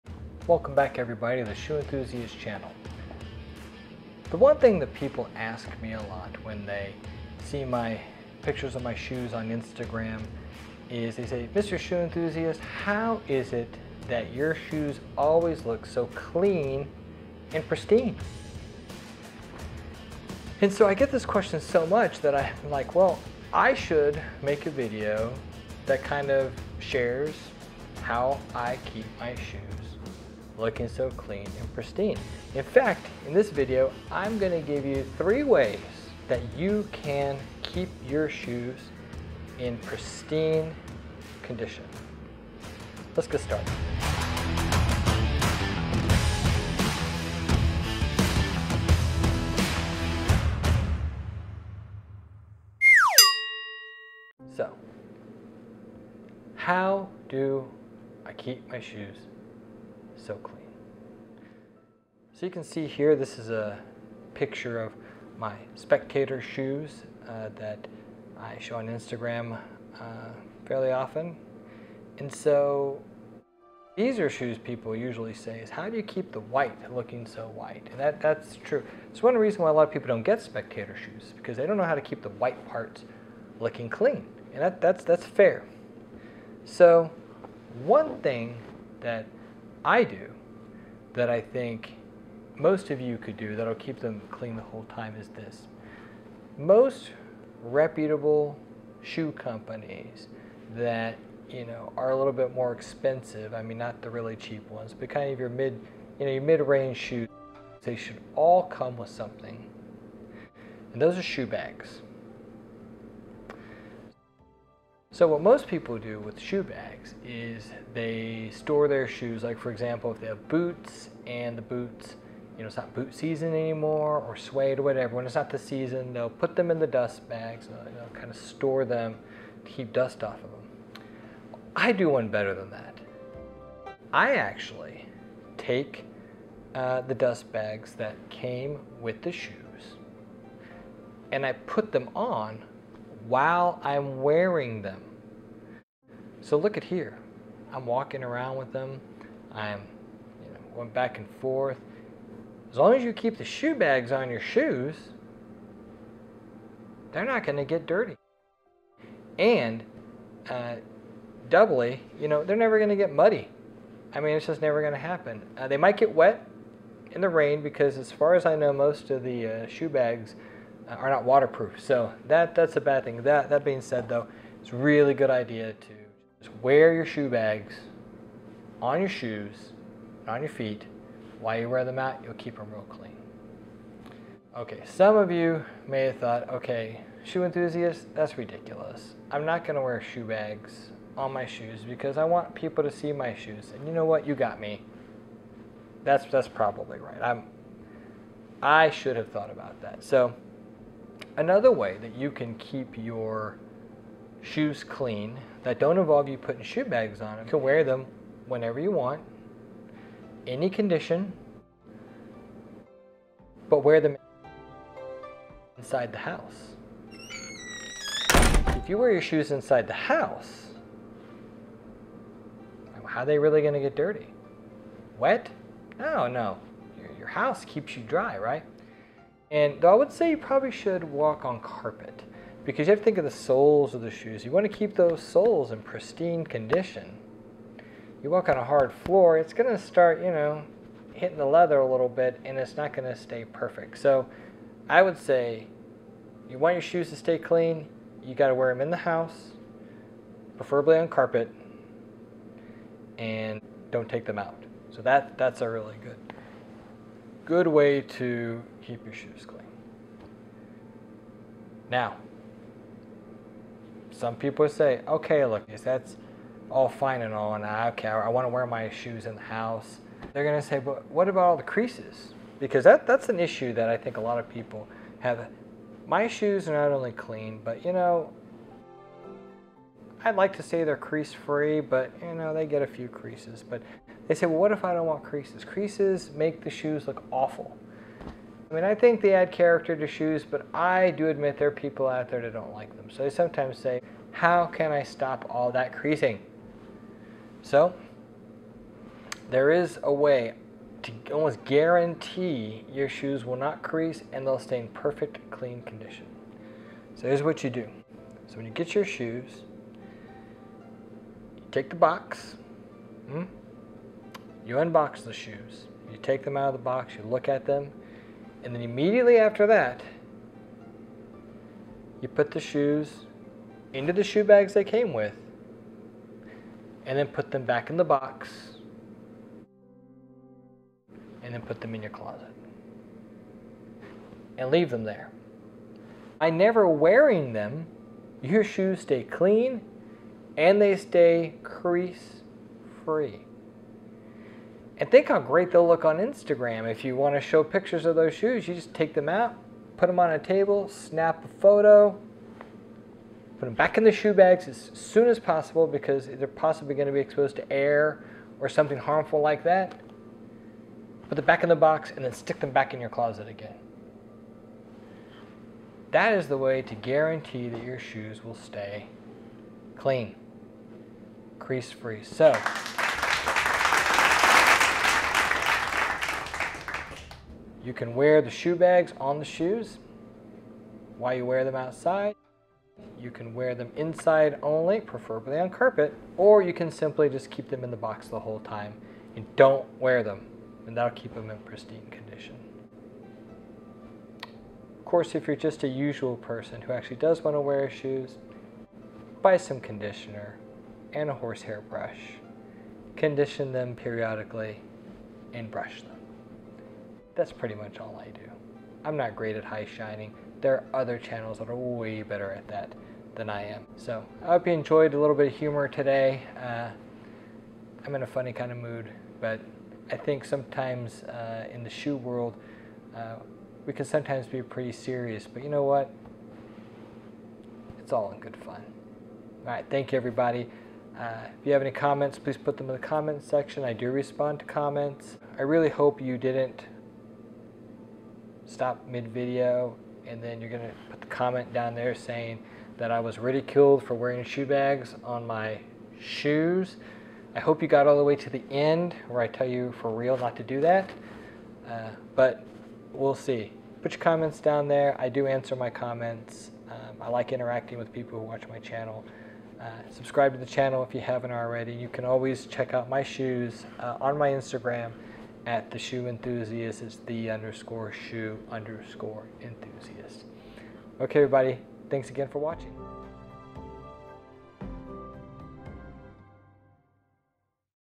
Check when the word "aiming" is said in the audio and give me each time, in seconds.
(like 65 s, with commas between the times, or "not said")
not said.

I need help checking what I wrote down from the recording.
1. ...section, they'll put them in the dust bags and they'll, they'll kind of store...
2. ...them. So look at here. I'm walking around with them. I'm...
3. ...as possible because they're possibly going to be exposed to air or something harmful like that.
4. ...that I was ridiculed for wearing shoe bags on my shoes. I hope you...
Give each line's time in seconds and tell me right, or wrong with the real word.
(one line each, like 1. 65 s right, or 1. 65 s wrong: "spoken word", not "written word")
1. 125 s wrong: "season", not "section"
2. 144 s right
3. 355 s right
4. 442 s right.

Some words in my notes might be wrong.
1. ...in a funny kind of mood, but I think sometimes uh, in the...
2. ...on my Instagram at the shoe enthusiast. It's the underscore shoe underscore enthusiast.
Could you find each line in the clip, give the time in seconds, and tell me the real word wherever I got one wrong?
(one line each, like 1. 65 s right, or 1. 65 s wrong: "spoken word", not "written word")
1. 418 s right
2. 464 s right.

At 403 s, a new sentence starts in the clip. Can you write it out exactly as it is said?
Condition them periodically and brush them.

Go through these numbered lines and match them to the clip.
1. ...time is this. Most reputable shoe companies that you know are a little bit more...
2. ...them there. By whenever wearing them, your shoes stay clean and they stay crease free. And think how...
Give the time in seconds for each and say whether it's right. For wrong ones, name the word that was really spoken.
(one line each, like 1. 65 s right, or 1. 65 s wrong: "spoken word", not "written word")
1. 94 s right
2. 334 s wrong: "never", not "whenever".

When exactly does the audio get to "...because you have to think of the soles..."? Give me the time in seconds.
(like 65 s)
232 s.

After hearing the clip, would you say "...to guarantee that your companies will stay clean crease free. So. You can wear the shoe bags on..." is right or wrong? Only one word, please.
wrong.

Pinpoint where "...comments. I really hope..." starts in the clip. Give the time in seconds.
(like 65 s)
434 s.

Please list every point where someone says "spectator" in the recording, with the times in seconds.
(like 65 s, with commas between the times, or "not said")
65 s, 80 s.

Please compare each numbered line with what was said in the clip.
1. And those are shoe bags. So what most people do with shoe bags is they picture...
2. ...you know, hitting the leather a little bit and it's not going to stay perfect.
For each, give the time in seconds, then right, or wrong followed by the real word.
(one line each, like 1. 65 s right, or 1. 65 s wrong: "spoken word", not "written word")
1. 110 s wrong: "store", not "picture"
2. 240 s right.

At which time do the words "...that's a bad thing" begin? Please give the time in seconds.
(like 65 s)
172 s.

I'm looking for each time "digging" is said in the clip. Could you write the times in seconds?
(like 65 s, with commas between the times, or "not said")
not said.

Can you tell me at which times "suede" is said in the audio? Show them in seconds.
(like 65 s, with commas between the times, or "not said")
124 s.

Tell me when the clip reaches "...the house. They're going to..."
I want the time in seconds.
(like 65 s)
269 s.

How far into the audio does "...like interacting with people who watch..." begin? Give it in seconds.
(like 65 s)
457 s.